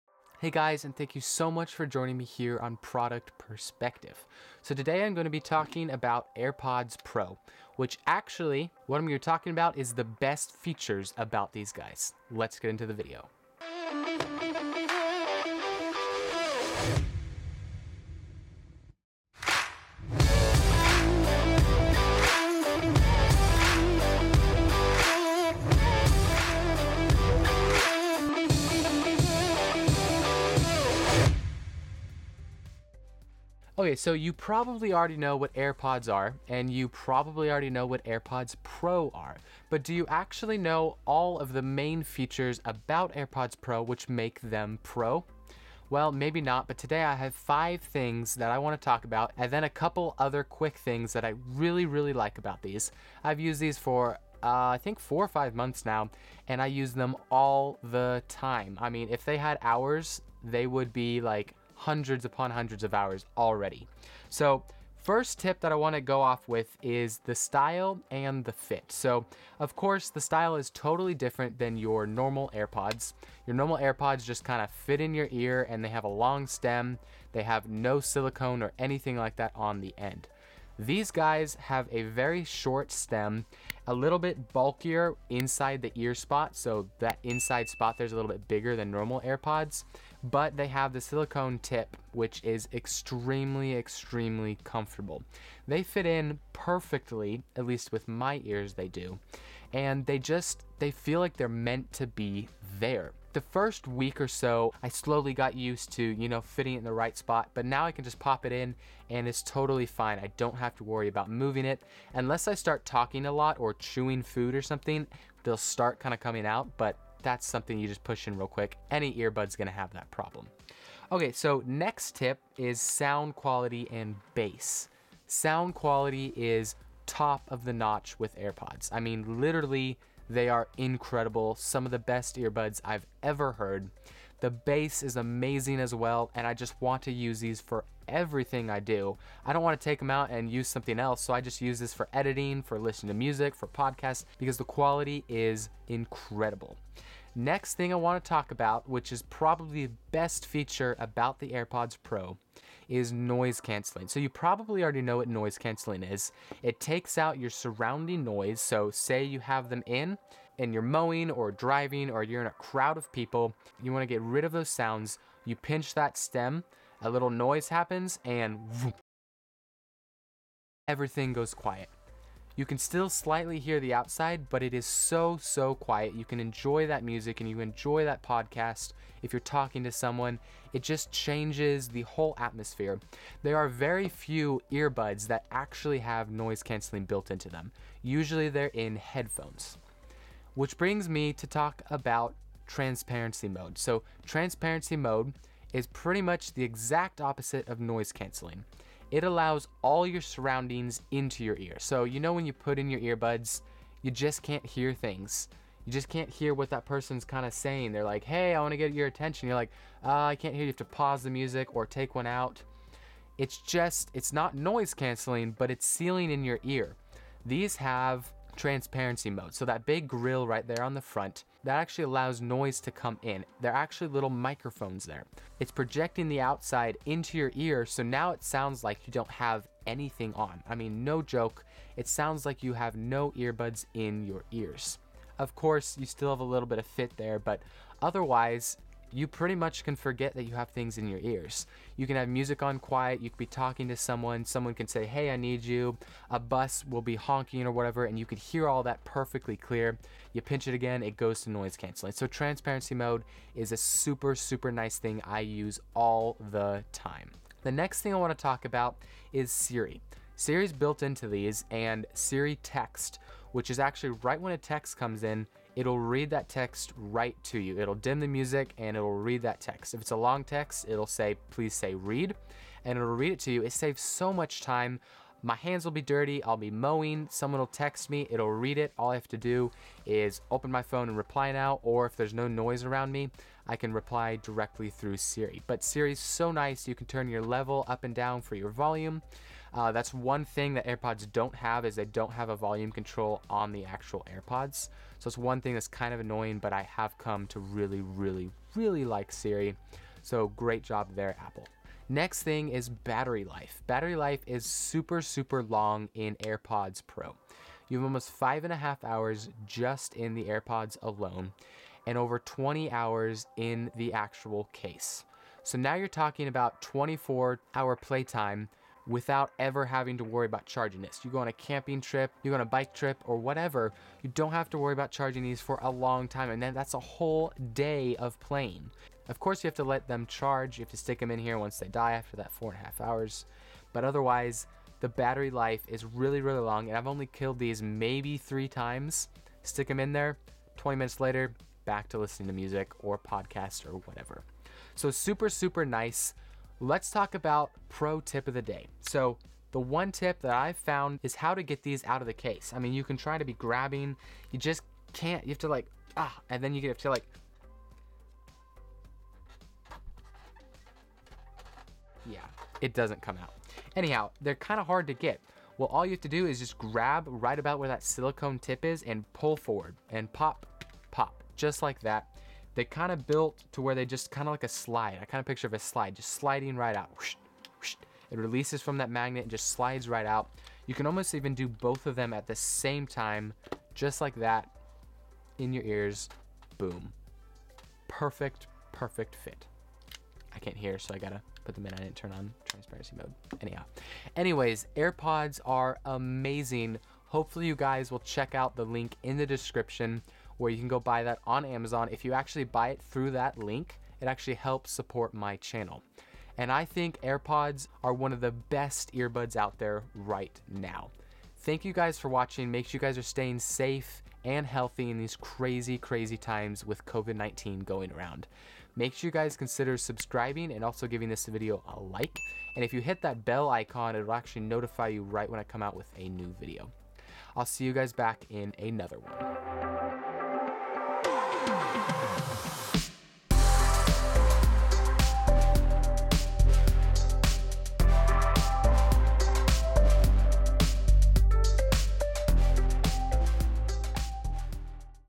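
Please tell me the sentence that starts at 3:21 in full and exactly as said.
So, you know, when you put in your earbuds, you just can't hear things.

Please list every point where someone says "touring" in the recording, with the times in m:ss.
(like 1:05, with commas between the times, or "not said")
not said.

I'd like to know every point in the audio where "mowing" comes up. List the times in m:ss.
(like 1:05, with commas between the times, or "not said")
2:40, 4:36.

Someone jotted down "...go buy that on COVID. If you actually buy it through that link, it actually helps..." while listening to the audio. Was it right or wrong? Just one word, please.
wrong.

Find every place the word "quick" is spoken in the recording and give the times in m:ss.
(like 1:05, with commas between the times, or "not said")
0:50, 1:58.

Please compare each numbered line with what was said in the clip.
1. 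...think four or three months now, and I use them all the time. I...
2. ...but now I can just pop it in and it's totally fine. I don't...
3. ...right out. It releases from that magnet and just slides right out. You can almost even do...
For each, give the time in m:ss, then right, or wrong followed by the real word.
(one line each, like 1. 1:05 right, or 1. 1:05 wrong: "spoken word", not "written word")
1. 0:54 wrong: "five", not "three"
2. 1:47 right
3. 6:16 right.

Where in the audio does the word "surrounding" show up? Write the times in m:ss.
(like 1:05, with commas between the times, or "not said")
2:37, 3:20.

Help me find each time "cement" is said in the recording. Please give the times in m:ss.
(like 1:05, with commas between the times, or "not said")
not said.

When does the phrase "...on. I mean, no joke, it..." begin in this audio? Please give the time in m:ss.
3:50.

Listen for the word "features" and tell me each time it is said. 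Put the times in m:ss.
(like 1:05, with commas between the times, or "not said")
0:10, 0:42, 2:30.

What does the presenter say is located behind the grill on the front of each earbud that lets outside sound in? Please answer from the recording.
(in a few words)
microphones.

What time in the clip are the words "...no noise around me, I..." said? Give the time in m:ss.
4:42.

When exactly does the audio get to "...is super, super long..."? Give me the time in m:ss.
5:04.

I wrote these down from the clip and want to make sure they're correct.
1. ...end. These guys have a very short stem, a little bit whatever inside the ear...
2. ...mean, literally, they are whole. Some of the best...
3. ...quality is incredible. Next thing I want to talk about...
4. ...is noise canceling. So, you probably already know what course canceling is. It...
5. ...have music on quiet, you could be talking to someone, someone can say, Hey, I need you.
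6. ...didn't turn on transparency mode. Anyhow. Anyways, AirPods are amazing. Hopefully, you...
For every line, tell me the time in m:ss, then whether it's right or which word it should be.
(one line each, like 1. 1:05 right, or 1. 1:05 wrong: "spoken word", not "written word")
1. 1:19 wrong: "bulkier", not "whatever"
2. 2:09 wrong: "incredible", not "whole"
3. 2:24 right
4. 2:32 wrong: "noise", not "course"
5. 4:02 right
6. 6:31 right.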